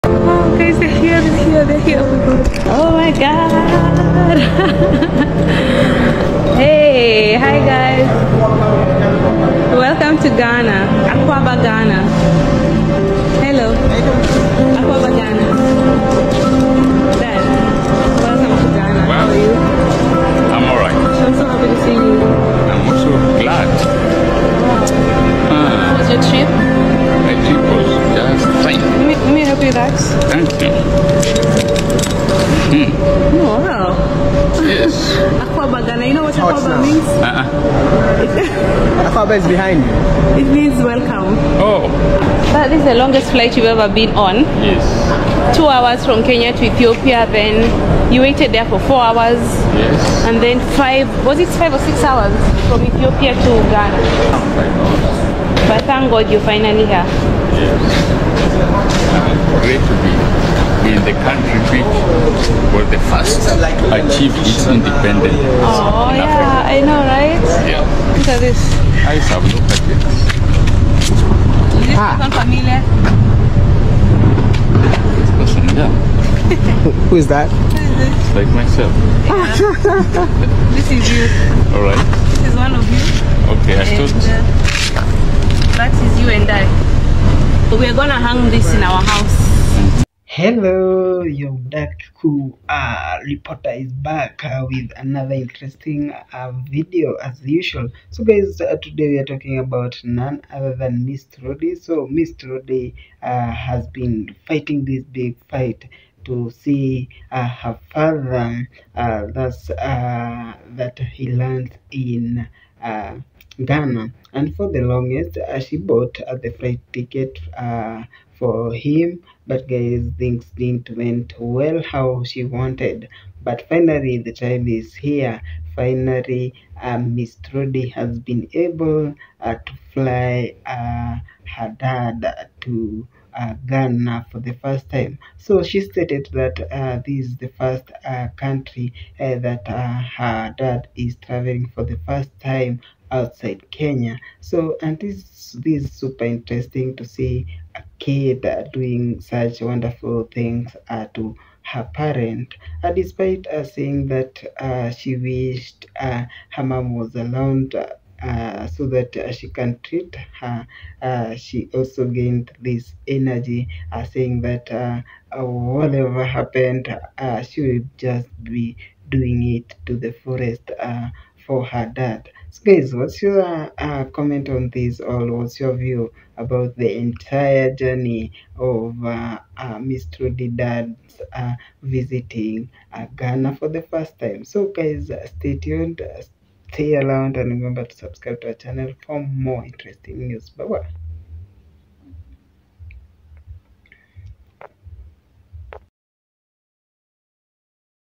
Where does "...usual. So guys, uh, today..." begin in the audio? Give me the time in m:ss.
1:37.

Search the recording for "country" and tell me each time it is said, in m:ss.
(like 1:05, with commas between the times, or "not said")
1:01, 2:18.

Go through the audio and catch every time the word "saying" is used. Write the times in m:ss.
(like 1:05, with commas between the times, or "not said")
2:33, 2:44.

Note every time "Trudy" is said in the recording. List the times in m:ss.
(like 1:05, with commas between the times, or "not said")
2:07, 3:00.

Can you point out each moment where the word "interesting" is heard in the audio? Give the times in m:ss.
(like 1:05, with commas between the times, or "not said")
1:35, 2:26, 3:09.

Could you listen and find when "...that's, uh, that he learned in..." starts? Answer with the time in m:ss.
1:49.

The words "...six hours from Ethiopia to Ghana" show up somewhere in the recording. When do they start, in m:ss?
0:51.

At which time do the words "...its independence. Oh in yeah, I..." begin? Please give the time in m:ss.
1:04.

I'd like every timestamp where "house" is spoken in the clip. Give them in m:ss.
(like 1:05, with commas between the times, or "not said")
1:29.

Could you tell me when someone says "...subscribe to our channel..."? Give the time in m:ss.
3:07.